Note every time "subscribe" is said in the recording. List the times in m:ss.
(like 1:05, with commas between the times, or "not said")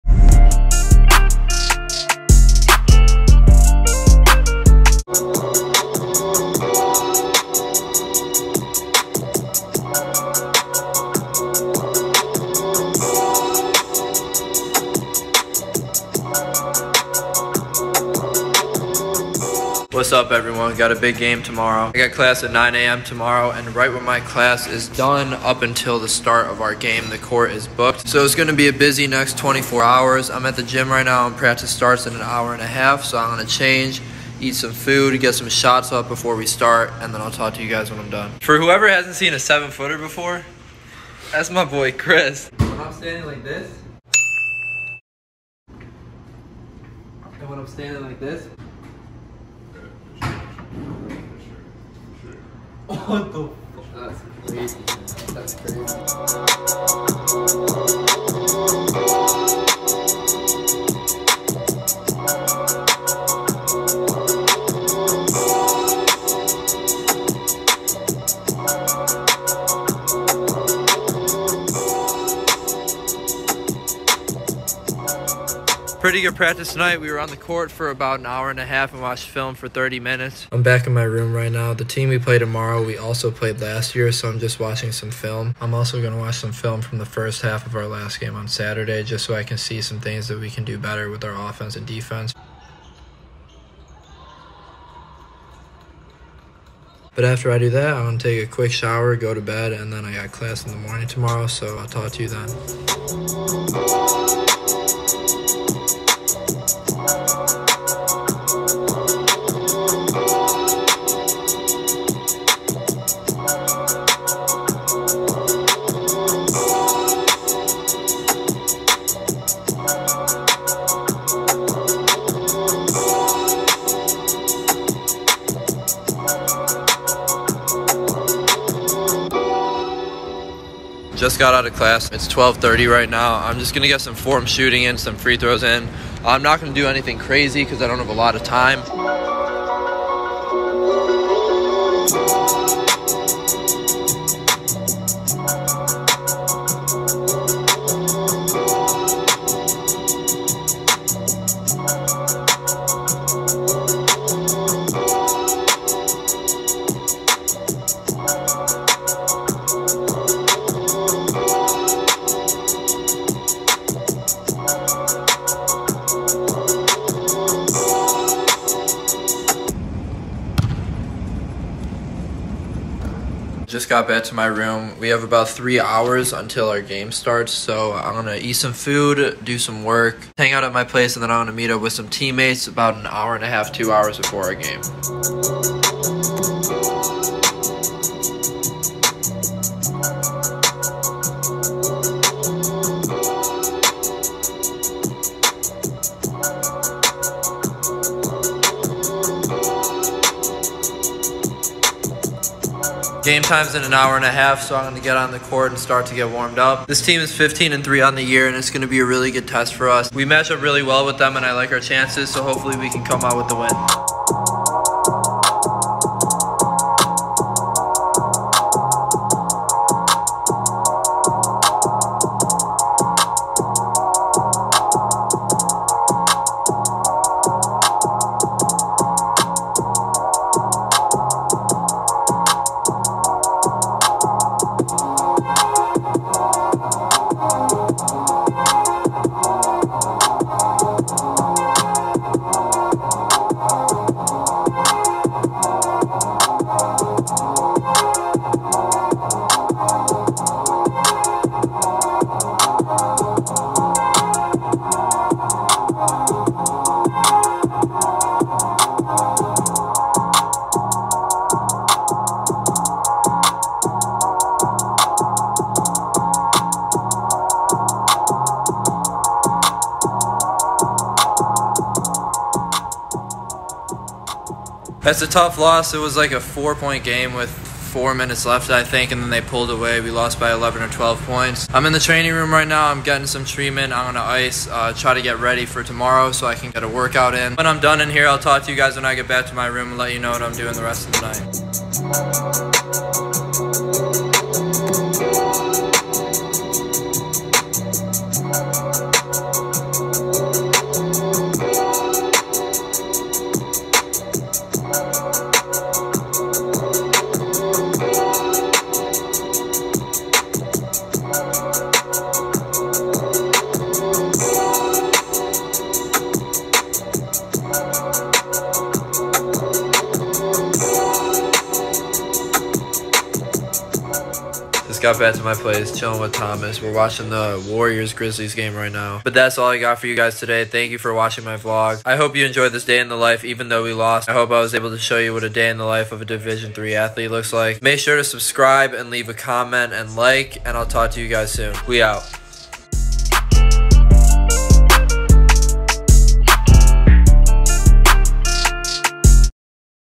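5:38.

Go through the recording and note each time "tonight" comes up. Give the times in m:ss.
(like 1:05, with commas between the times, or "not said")
1:16.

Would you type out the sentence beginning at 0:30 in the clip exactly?
I'm at the gym right now and practice starts in an hour and a half.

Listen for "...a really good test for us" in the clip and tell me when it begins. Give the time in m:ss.
3:28.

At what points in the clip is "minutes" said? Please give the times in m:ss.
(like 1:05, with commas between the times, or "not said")
1:20, 4:38.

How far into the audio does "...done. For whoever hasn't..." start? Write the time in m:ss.
0:38.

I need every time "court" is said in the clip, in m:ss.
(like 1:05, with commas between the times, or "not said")
0:27, 1:17, 3:25.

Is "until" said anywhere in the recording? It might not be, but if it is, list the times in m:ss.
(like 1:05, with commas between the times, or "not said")
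0:25, 2:56.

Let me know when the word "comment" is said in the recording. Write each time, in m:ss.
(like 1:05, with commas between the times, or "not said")
5:39.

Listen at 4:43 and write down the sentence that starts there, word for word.
I'm on the ice, uh, try to get ready for tomorrow so I can get a workout in.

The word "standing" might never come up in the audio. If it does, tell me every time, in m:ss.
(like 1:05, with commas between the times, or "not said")
0:42, 0:47.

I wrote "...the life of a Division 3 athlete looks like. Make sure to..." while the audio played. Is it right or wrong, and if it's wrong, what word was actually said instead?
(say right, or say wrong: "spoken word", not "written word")
right.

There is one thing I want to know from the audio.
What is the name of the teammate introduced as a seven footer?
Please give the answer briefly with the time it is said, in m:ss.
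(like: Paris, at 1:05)
Chris, at 0:41.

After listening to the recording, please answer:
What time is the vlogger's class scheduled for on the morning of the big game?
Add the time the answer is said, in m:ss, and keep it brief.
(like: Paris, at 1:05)
9 a.m., at 0:22.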